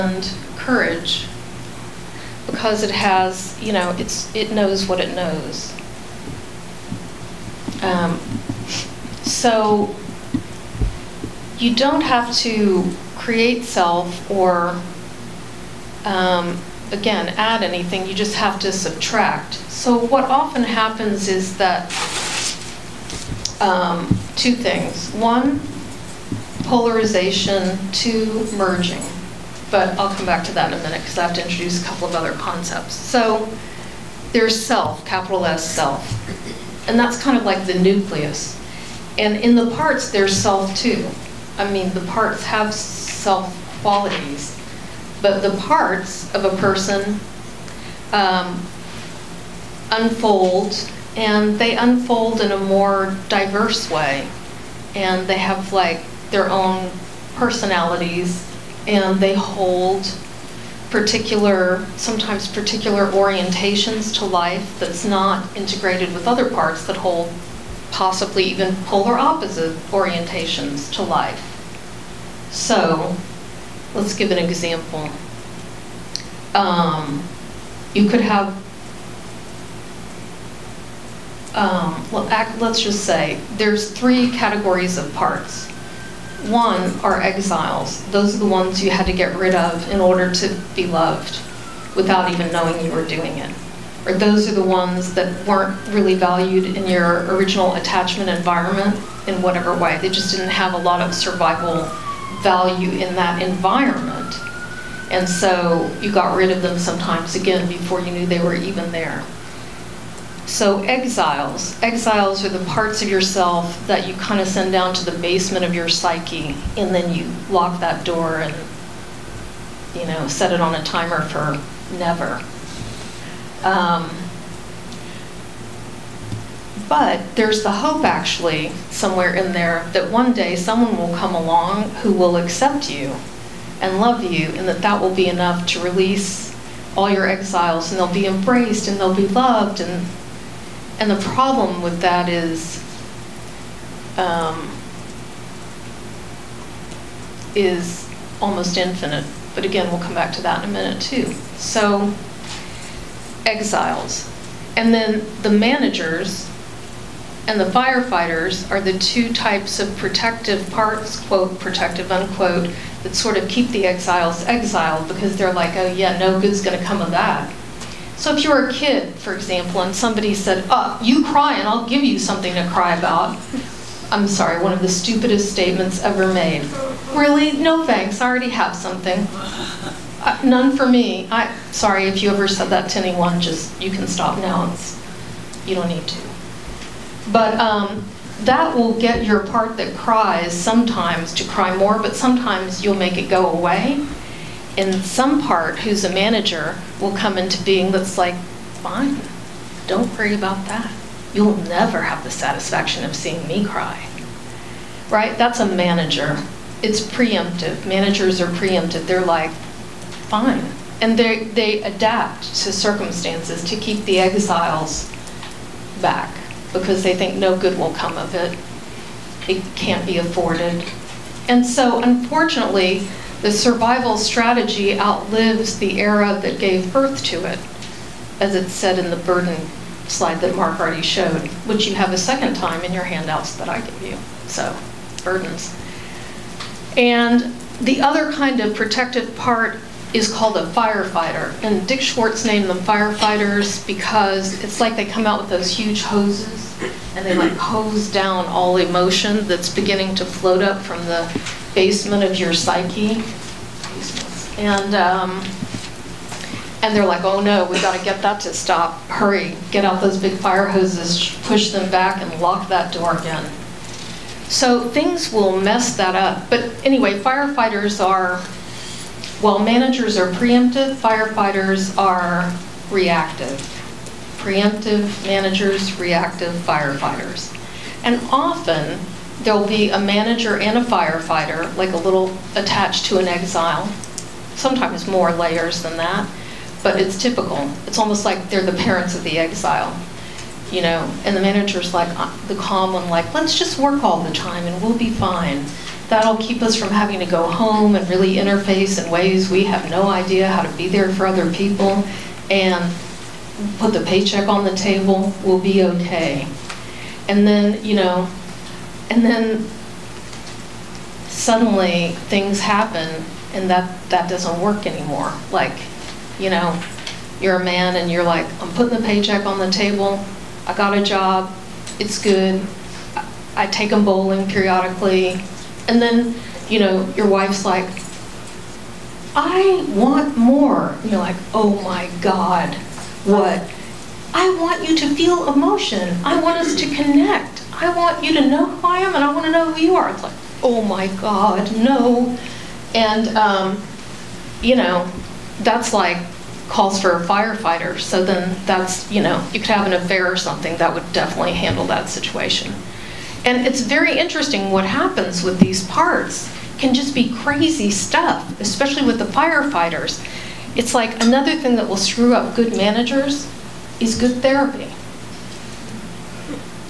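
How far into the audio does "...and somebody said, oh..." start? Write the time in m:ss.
2:49.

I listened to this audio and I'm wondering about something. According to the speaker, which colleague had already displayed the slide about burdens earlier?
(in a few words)
Mark.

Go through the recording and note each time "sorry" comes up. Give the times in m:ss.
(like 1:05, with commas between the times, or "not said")
2:54, 3:01.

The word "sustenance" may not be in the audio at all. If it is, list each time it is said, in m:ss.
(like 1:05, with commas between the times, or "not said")
not said.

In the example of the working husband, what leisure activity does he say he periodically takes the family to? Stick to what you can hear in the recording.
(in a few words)
Bowling.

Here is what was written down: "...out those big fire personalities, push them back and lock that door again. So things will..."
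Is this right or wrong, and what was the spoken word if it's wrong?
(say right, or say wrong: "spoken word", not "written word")
wrong: "hoses", not "personalities".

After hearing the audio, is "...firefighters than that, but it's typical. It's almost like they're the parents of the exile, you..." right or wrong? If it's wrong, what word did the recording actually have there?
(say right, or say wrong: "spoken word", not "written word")
wrong: "layers", not "firefighters".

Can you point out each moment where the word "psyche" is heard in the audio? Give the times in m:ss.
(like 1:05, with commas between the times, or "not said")
1:55, 4:12.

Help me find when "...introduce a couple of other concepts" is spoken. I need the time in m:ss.
0:31.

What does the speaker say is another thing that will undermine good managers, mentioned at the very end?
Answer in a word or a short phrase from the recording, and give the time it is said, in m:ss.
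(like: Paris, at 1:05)
Good therapy, at 6:04.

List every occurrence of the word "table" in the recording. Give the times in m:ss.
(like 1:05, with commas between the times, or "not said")
5:04, 5:19.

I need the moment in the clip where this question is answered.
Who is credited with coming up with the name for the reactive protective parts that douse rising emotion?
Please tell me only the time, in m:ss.
4:01.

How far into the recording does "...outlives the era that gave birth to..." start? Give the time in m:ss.
3:44.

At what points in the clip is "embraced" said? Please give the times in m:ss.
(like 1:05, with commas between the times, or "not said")
2:18.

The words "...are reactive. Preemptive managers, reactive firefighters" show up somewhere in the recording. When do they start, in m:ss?
4:31.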